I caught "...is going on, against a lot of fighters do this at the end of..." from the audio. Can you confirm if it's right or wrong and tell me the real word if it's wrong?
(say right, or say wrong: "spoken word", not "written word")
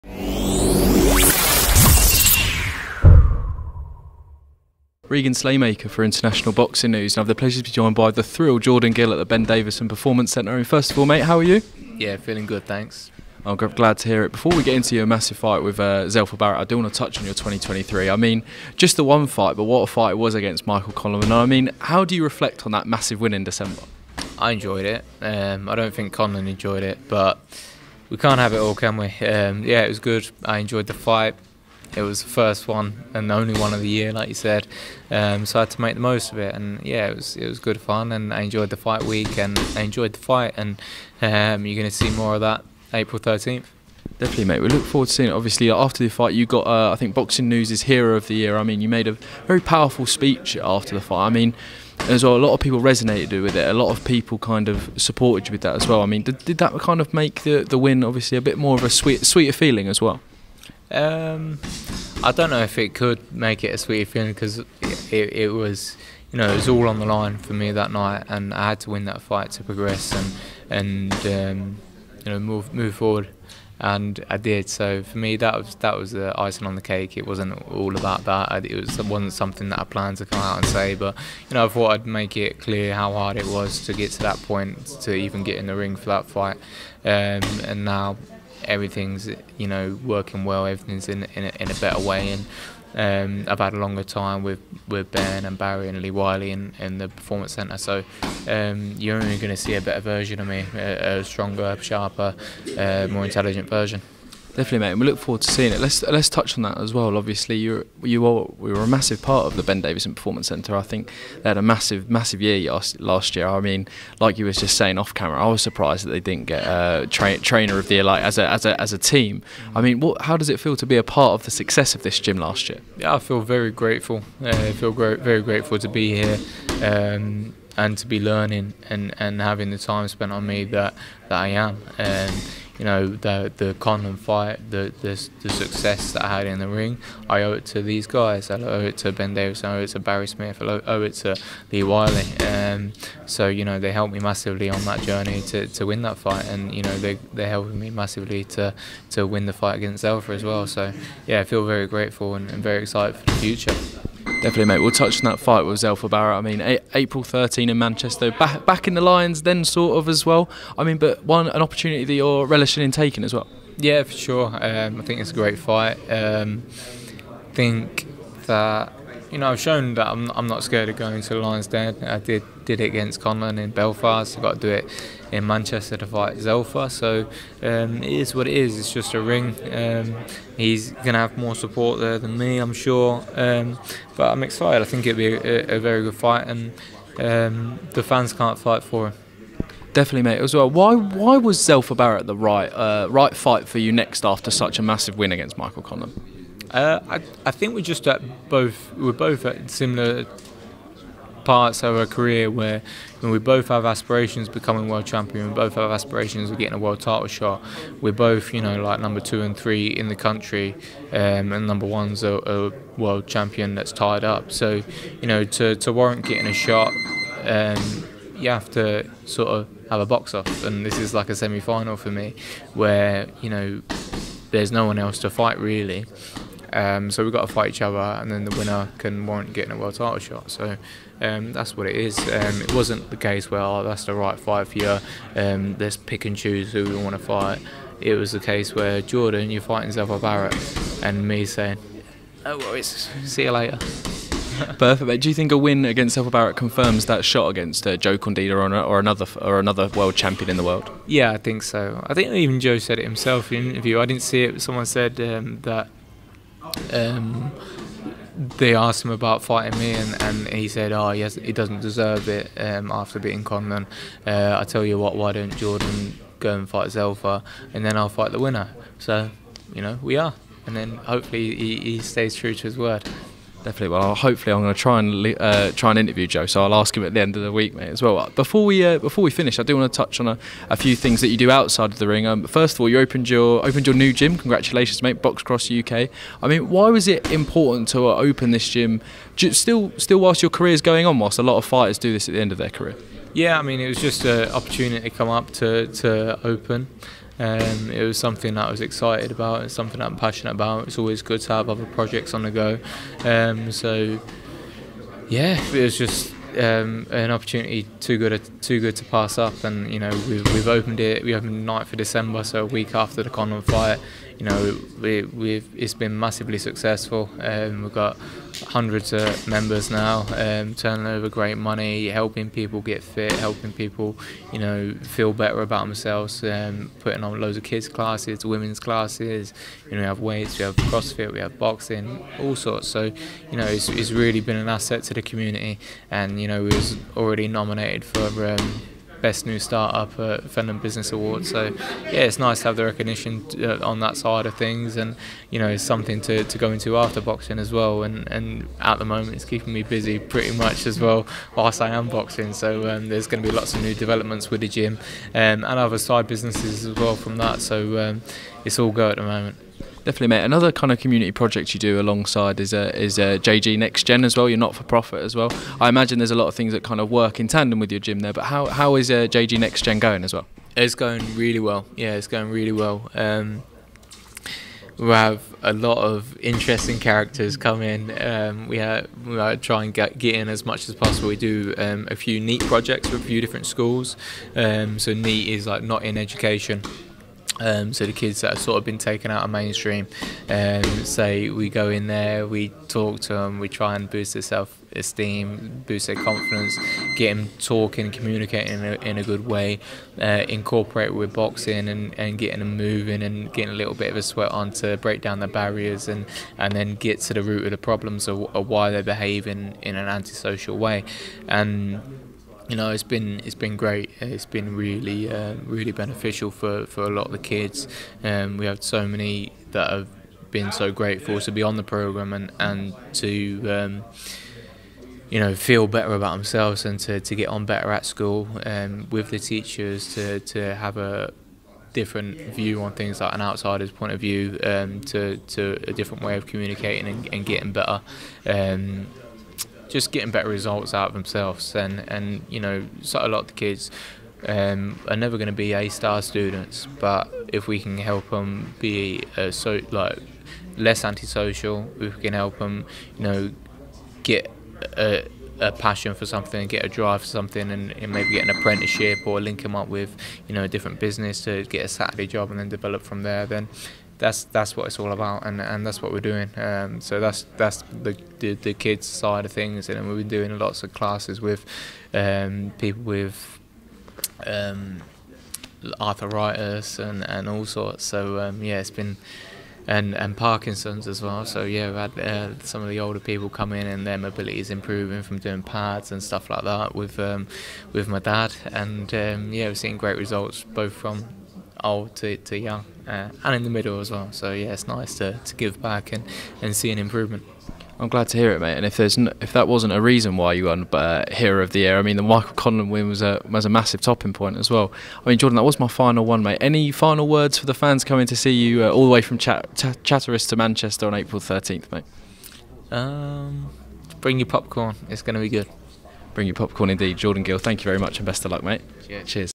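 wrong: "whilst", not "against".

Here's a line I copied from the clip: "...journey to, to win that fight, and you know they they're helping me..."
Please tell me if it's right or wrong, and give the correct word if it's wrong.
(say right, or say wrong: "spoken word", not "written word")
right.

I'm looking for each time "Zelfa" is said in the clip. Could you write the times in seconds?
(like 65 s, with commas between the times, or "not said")
16 s, 150 s, 155 s, 176 s, 191 s, 239 s, 246 s, 266 s.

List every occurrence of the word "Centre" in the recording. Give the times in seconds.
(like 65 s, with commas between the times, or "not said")
10 s, 97 s, 110 s.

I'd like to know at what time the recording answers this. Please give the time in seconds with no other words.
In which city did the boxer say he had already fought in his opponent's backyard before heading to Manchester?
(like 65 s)
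173 s.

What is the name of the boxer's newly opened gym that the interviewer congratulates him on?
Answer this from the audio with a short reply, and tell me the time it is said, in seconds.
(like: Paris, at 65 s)
BoxCross UK, at 285 s.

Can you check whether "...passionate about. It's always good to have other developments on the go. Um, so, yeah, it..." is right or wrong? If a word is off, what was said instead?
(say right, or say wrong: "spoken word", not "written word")
wrong: "projects", not "developments".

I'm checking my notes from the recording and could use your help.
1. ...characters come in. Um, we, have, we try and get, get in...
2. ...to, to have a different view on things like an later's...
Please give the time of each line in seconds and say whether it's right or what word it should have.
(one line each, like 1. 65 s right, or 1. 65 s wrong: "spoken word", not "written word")
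1. 376 s right
2. 430 s wrong: "outsider", not "later".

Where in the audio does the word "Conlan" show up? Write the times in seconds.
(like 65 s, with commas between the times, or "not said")
20 s, 26 s, 133 s, 173 s, 195 s, 263 s, 502 s.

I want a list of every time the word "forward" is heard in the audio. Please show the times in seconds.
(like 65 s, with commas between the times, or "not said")
44 s, 72 s, 105 s.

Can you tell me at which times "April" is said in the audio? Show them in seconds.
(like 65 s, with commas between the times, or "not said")
42 s, 156 s, 511 s.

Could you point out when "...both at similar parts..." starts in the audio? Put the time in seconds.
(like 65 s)
199 s.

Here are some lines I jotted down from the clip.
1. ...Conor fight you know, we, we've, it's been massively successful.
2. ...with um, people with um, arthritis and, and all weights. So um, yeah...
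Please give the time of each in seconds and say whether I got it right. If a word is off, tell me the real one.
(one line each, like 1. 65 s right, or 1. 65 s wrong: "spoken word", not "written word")
1. 313 s right
2. 471 s wrong: "sorts", not "weights".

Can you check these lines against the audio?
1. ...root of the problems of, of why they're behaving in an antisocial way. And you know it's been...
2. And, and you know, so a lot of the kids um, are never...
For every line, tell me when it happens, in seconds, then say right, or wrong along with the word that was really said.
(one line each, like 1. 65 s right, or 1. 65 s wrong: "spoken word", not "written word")
1. 407 s right
2. 441 s right.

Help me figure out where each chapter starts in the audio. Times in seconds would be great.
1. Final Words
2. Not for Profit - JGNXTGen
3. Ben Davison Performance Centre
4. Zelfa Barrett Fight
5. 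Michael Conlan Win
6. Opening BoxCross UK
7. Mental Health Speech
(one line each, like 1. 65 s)
1. 505 s
2. 360 s
3. 106 s
4. 154 s
5. 18 s
6. 244 s
7. 46 s.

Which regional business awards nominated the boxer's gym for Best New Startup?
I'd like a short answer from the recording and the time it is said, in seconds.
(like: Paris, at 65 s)
Fenland Business Awards, at 340 s.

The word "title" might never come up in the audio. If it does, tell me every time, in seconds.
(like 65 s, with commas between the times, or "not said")
207 s, 229 s.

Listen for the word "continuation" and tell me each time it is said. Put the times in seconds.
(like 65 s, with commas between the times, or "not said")
not said.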